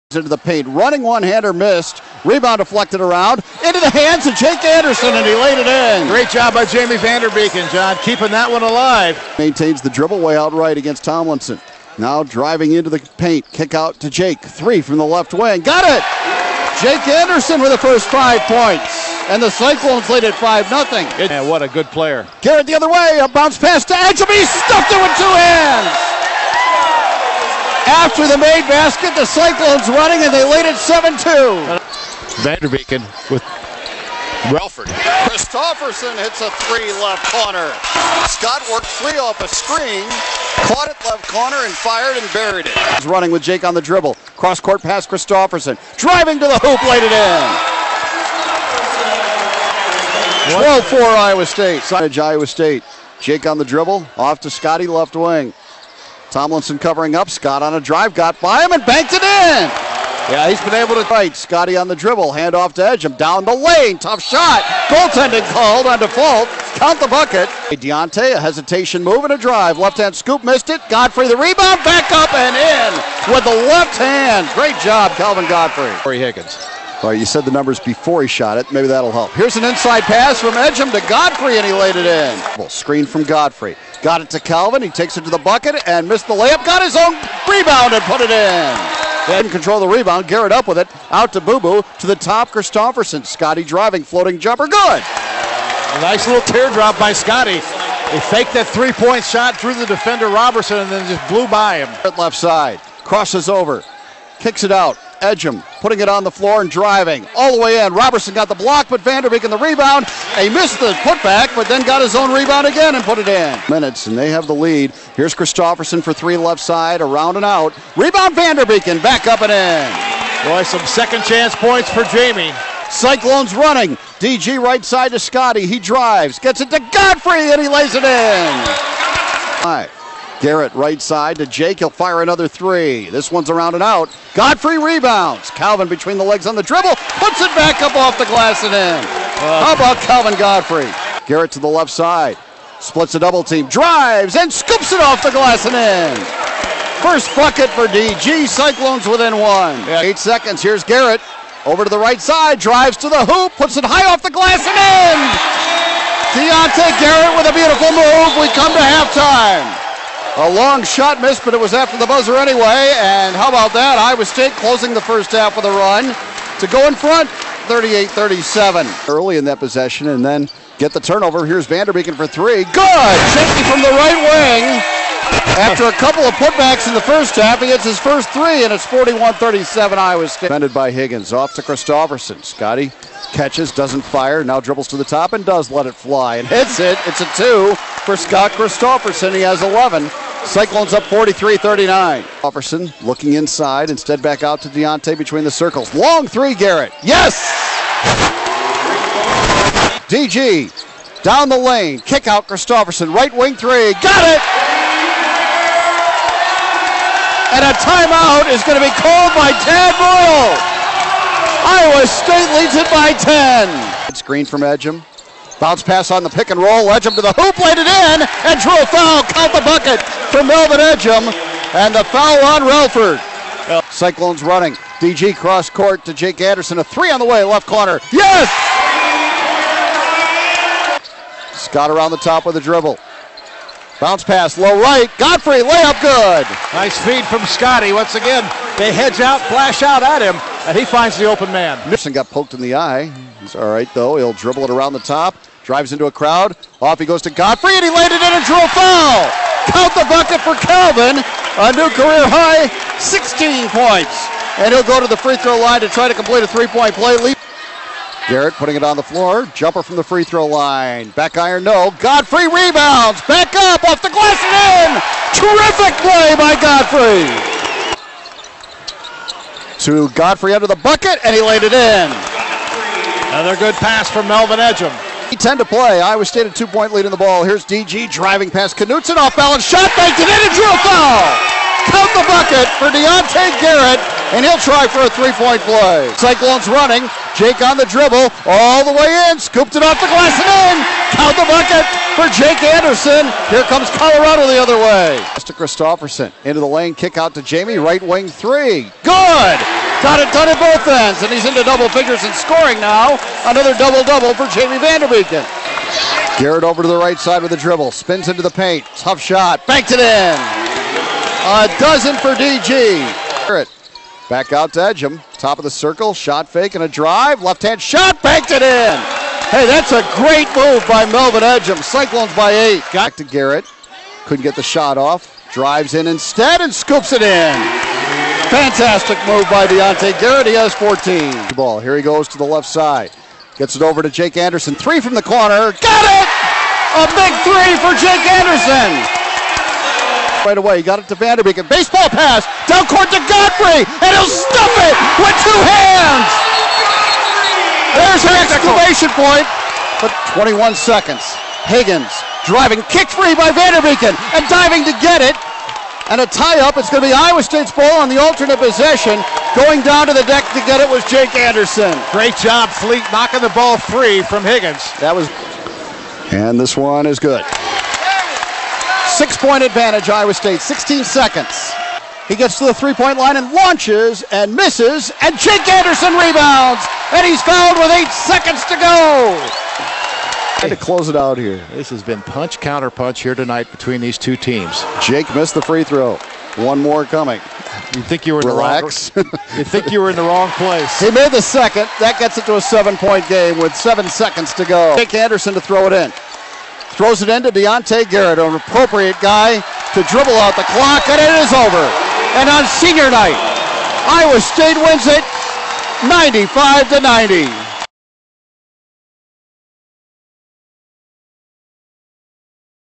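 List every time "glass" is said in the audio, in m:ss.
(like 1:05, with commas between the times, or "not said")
2:18, 2:25, 2:34, 4:24, 4:50.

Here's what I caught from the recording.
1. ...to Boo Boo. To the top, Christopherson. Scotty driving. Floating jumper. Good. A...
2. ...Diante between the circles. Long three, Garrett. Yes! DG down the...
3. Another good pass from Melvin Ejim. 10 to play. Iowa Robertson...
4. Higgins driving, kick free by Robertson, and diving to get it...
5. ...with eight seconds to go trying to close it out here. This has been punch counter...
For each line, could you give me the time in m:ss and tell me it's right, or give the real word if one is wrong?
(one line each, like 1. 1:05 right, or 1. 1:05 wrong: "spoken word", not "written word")
1. 1:31 right
2. 3:14 right
3. 4:33 wrong: "State", not "Robertson"
4. 5:51 wrong: "Vanderbeek", not "Robertson"
5. 6:17 right.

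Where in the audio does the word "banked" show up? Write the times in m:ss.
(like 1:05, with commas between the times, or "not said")
0:58, 4:39, 5:09, 5:18.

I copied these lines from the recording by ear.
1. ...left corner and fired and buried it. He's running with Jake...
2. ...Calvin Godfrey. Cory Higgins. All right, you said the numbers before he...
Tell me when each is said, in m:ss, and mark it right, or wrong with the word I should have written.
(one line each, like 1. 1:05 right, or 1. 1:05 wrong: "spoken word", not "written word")
1. 0:41 right
2. 1:15 right.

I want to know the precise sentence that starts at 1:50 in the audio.
He missed the putback, but then got his own rebound again and put it in.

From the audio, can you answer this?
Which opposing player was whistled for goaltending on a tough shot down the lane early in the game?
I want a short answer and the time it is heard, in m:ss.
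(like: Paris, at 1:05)
Dufault, at 1:05.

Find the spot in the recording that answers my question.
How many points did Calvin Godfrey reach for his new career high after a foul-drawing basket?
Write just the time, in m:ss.
4:12.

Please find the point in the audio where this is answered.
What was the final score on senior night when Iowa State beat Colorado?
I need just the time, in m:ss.
6:46.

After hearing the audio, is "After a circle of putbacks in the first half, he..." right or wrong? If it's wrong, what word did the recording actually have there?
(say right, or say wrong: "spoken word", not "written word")
wrong: "couple", not "circle".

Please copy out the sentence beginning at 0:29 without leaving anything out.
The Cyclones running, and they lead it 7-2.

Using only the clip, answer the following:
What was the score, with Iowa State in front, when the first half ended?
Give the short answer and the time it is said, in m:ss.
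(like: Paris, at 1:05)
38-37, at 2:47.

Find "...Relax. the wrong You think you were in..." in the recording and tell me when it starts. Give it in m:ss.
6:28.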